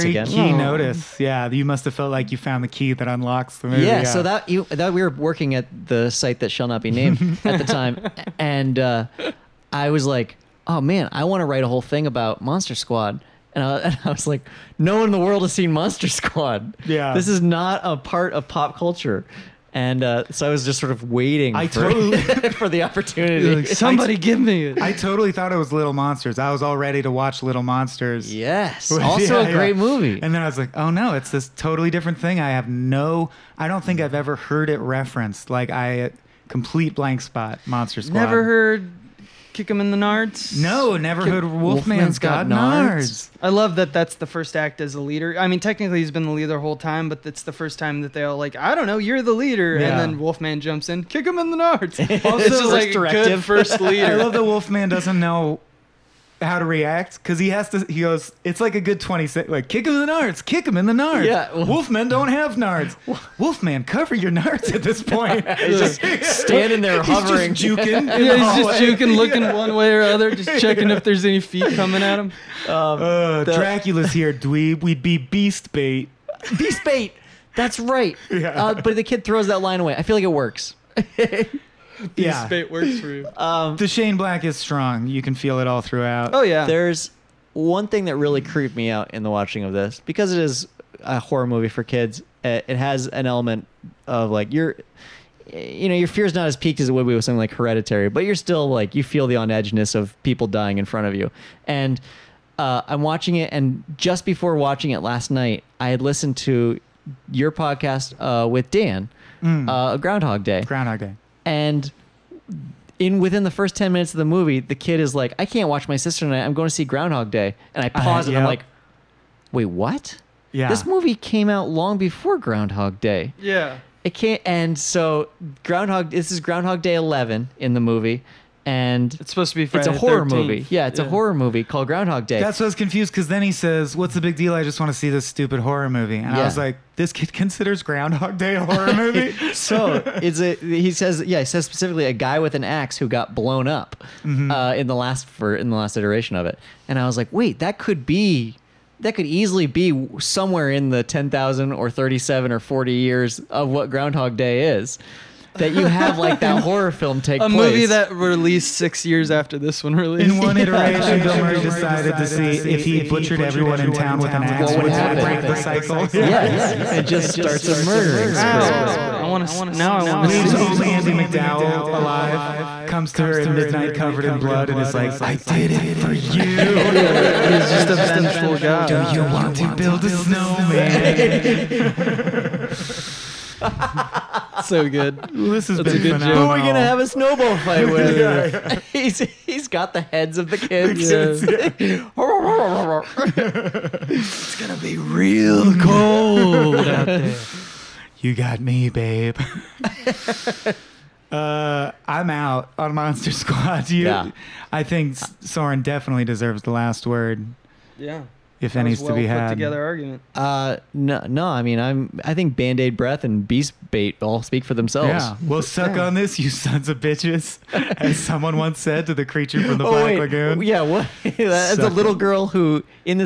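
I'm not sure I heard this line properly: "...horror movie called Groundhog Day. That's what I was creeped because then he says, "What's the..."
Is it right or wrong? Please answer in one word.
wrong.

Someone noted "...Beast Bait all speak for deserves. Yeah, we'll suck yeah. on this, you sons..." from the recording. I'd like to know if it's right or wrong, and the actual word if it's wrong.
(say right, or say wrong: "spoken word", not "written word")
wrong: "themselves", not "deserves".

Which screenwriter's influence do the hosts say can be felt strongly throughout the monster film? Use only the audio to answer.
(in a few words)
Shane Black.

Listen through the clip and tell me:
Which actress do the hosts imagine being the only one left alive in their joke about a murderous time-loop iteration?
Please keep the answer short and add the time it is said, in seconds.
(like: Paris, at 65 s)
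Andie MacDowell, at 170 s.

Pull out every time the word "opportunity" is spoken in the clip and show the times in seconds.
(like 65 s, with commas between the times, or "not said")
22 s.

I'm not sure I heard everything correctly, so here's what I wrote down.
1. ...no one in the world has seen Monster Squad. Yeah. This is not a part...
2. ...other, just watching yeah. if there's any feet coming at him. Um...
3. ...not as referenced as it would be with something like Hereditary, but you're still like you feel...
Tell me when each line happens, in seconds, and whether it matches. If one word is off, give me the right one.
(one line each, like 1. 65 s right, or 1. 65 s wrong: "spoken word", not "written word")
1. 14 s right
2. 70 s wrong: "checking", not "watching"
3. 96 s wrong: "peaked", not "referenced".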